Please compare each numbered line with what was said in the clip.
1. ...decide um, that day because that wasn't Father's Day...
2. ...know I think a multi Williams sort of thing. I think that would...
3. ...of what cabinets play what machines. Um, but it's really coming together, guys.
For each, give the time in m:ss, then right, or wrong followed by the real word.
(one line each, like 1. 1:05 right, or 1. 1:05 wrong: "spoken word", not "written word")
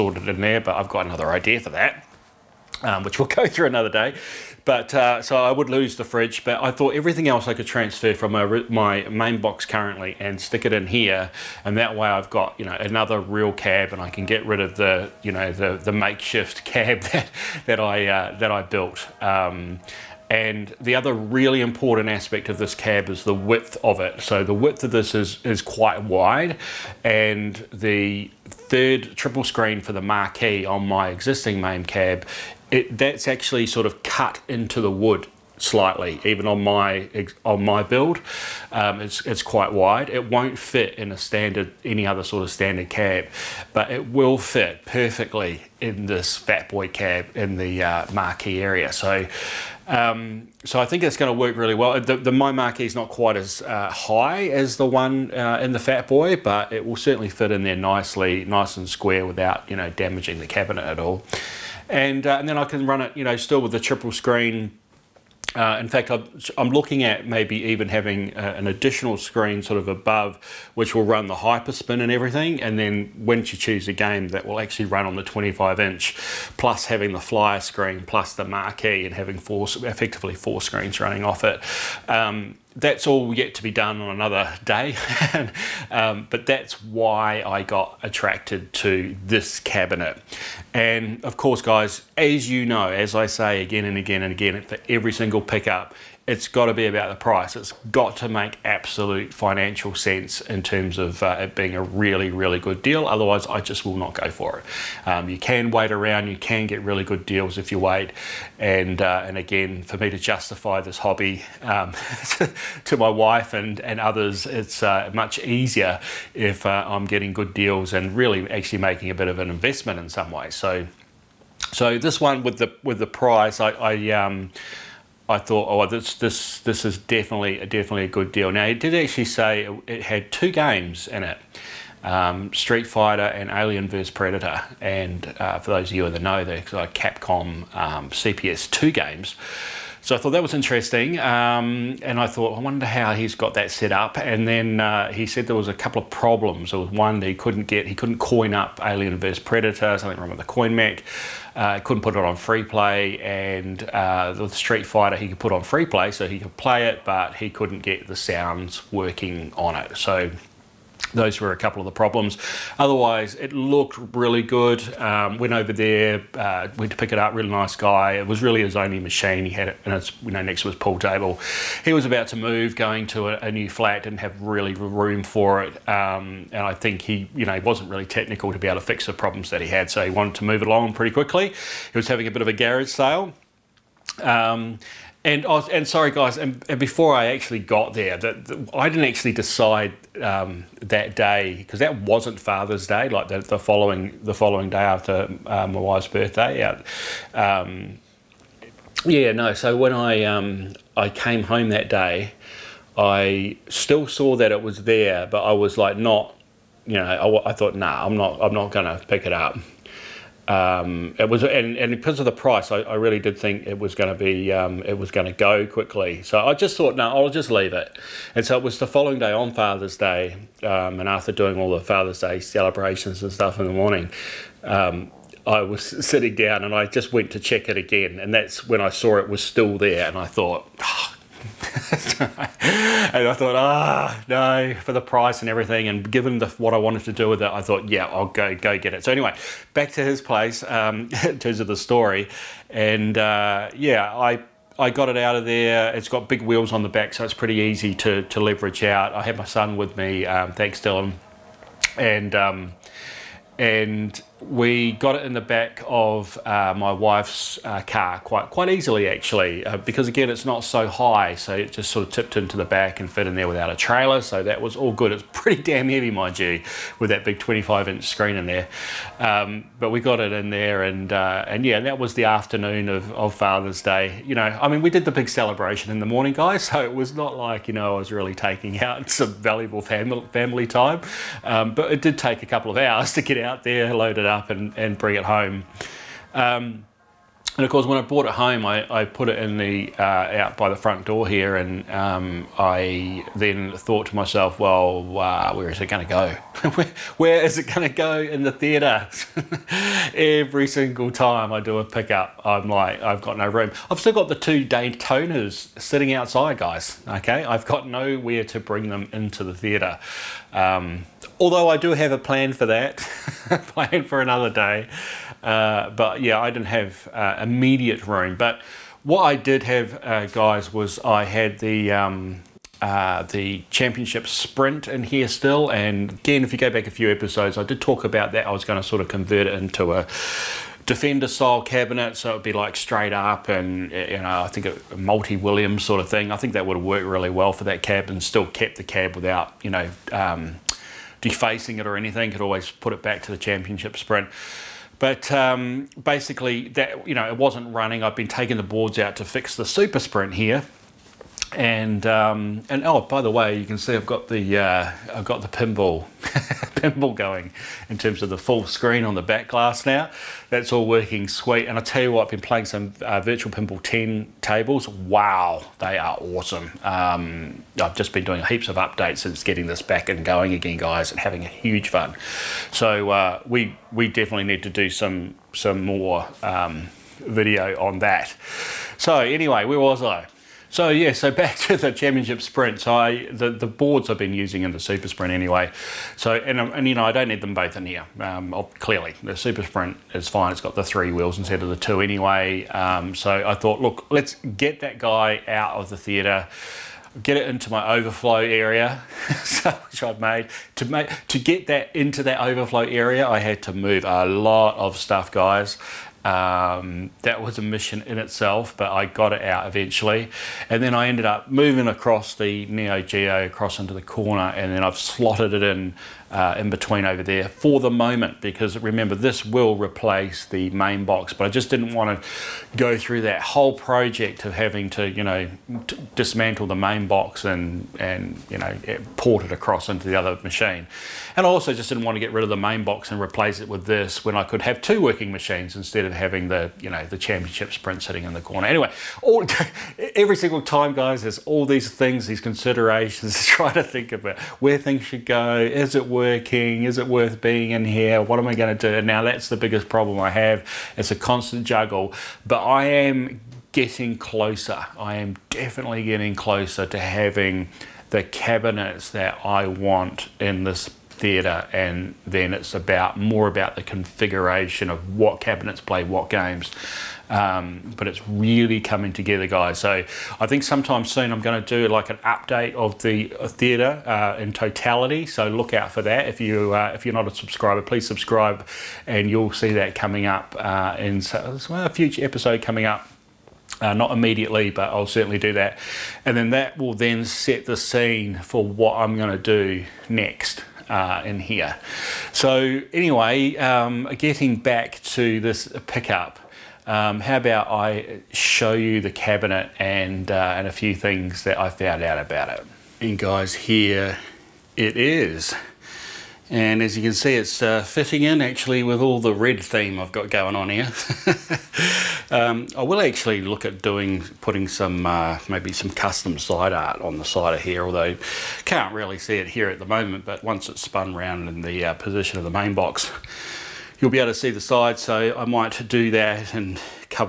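1. 3:09 right
2. 5:34 right
3. 7:44 wrong: "games", not "machines".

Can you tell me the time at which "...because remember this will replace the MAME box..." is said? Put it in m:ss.
6:58.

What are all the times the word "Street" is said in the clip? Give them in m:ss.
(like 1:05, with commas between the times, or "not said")
2:12, 2:34.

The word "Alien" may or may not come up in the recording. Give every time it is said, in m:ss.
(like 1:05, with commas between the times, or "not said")
2:13, 2:28.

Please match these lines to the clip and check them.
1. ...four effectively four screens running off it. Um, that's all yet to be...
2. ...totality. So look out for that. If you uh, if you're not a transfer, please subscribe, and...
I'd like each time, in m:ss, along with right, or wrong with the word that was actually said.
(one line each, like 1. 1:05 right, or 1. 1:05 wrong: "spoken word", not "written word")
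1. 1:19 right
2. 7:54 wrong: "subscriber", not "transfer".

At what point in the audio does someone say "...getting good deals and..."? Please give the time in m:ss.
1:57.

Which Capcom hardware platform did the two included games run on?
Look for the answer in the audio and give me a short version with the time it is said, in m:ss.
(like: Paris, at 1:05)
CPS2, at 2:18.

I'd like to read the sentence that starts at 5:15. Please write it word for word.
Uh, but yeah, I didn't have uh, immediate room.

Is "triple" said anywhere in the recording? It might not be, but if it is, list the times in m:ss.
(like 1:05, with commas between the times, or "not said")
0:29, 1:03.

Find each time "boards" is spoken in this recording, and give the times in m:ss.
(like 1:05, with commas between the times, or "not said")
5:48, 6:23.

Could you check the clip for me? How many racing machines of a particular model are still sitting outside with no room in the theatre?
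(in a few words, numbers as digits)
2.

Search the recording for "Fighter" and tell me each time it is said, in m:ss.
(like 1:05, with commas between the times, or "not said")
2:12, 2:34.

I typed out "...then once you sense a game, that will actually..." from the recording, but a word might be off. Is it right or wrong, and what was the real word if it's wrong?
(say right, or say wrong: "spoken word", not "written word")
wrong: "choose", not "sense".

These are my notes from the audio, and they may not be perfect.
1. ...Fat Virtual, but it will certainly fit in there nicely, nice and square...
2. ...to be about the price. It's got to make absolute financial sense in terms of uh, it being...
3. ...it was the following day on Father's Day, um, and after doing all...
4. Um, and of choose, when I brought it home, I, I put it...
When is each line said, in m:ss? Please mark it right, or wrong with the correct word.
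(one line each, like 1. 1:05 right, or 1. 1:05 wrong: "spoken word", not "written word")
1. 0:55 wrong: "Boy", not "Virtual"
2. 1:36 right
3. 3:38 right
4. 4:46 wrong: "course", not "choose".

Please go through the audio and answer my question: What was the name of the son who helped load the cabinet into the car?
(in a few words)
Dylan.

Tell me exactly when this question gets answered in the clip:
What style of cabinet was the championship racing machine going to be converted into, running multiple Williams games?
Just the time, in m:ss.
5:30.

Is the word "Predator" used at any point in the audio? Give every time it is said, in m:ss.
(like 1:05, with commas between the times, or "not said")
2:14, 2:29.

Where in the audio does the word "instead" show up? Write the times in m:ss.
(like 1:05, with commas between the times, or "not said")
6:31, 7:15.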